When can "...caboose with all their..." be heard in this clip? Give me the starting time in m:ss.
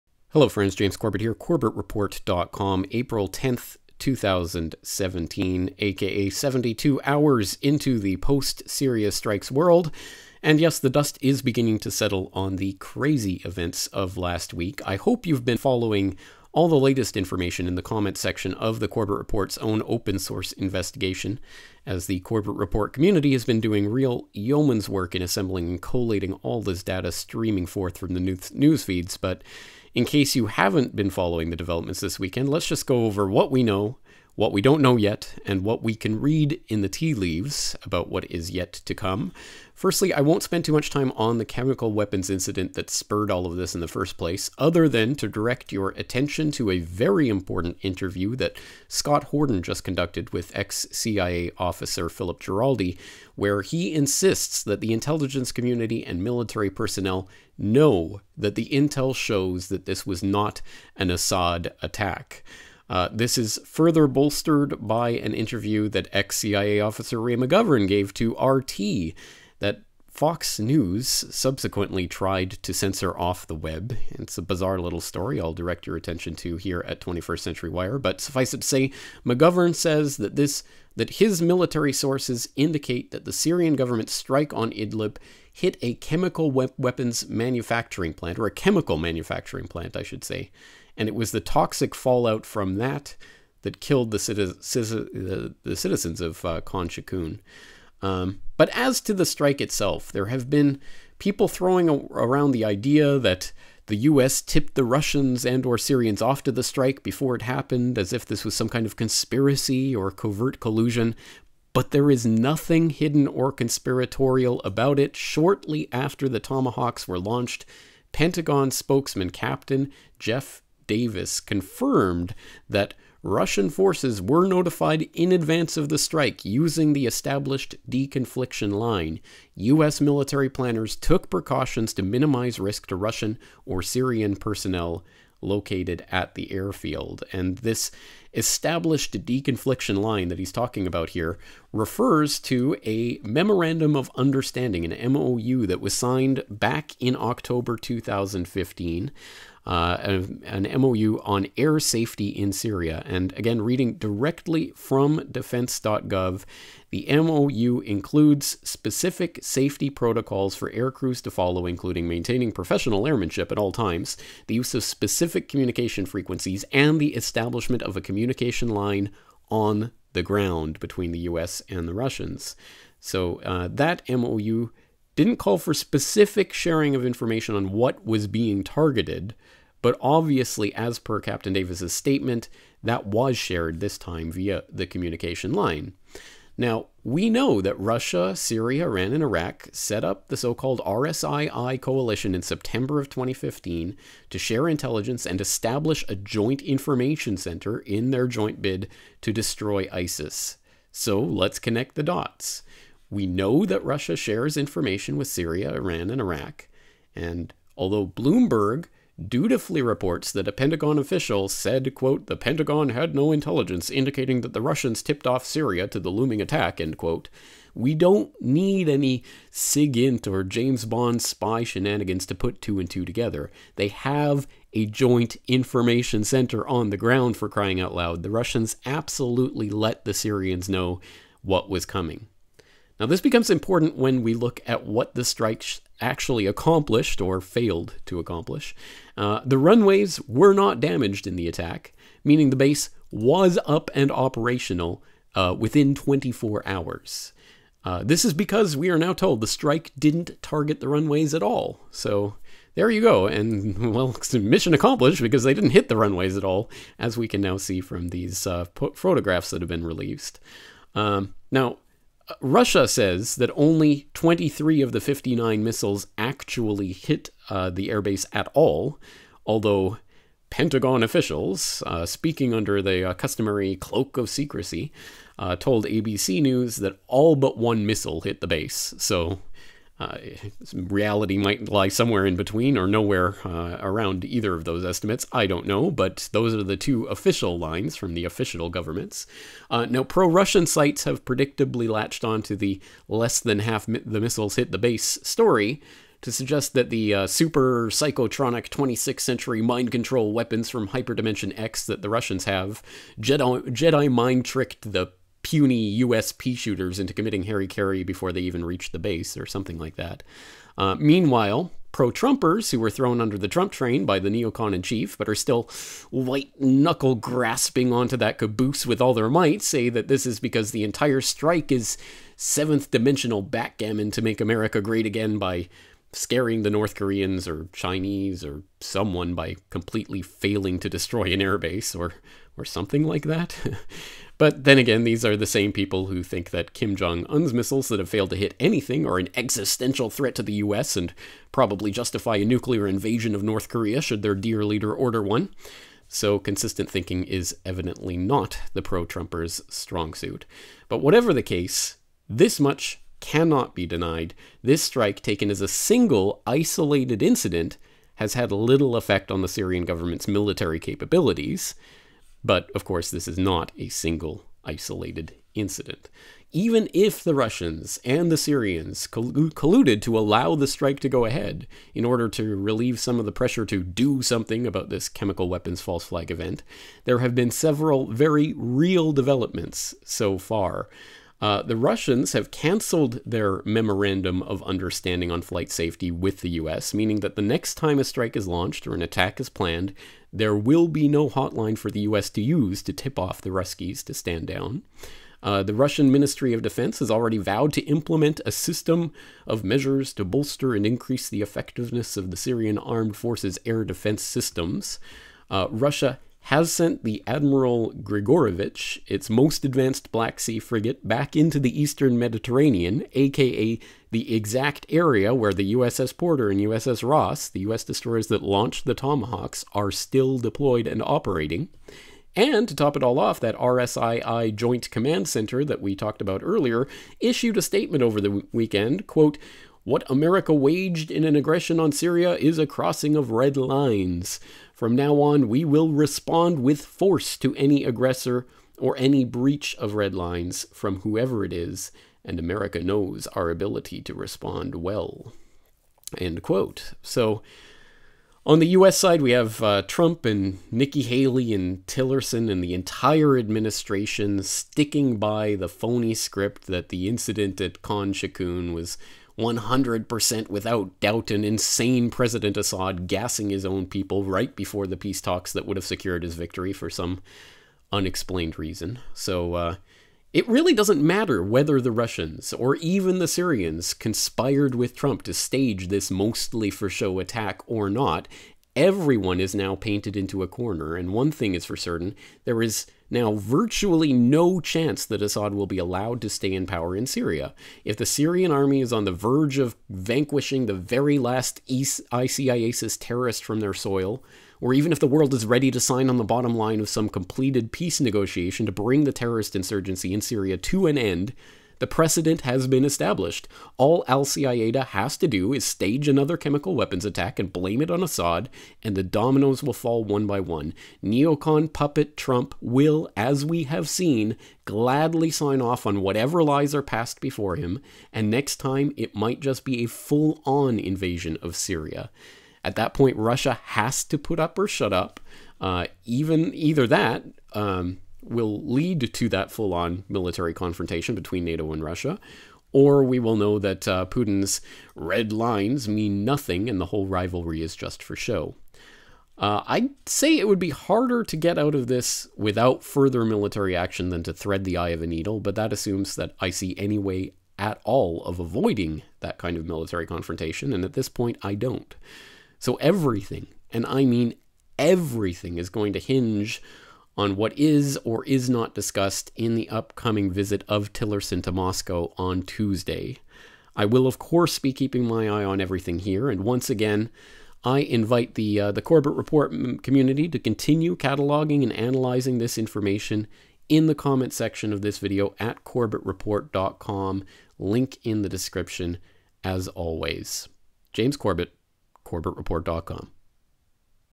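5:18.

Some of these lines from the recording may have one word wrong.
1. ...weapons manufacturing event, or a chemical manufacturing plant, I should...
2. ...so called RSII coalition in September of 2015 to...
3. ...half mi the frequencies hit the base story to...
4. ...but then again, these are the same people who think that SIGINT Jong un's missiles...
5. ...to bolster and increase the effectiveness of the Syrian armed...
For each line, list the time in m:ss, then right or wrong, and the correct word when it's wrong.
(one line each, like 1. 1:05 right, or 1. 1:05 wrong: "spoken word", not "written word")
1. 1:26 wrong: "plant", not "event"
2. 3:10 right
3. 4:53 wrong: "missiles", not "frequencies"
4. 5:34 wrong: "Kim", not "SIGINT"
5. 6:40 right.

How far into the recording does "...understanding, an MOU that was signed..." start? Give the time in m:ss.
2:24.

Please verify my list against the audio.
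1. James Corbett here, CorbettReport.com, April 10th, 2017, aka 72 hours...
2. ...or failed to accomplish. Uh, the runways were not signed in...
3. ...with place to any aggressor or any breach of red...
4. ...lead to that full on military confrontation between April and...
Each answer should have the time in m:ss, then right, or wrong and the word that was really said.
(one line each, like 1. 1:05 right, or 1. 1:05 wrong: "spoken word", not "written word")
1. 0:00 right
2. 3:57 wrong: "damaged", not "signed"
3. 7:16 wrong: "force", not "place"
4. 8:48 wrong: "NATO", not "April".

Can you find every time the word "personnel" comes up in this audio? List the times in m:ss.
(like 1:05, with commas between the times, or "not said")
0:56, 2:14.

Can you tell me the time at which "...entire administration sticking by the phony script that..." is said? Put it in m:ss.
7:32.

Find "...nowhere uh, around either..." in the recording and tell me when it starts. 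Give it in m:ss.
4:42.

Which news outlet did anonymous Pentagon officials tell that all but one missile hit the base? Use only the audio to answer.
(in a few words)
ABC News.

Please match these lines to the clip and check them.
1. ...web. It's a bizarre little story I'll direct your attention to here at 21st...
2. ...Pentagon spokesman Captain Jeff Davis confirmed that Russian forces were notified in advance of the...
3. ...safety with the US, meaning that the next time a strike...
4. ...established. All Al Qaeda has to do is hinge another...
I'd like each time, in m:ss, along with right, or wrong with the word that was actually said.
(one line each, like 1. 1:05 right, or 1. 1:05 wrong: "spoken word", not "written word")
1. 1:13 right
2. 1:58 right
3. 6:25 right
4. 8:22 wrong: "stage", not "hinge".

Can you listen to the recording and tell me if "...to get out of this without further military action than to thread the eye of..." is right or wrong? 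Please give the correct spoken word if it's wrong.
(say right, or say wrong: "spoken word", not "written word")
right.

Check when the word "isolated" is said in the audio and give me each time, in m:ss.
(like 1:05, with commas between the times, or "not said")
5:56, 6:04.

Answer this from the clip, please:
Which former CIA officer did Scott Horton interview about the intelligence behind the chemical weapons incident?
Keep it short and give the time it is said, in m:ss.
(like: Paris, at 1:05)
Philip Giraldi, at 0:52.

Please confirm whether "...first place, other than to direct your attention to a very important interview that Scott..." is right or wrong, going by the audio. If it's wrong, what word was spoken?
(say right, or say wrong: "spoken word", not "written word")
right.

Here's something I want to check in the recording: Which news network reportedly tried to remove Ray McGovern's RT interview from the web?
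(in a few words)
Fox News.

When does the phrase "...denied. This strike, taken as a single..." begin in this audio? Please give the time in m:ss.
5:53.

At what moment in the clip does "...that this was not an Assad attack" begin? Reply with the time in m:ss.
0:59.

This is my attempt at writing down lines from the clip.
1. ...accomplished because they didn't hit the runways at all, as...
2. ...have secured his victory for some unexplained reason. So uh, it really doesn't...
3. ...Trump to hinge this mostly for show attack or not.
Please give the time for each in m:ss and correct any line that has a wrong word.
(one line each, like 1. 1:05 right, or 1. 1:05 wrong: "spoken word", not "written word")
1. 4:14 right
2. 7:45 right
3. 7:54 wrong: "stage", not "hinge".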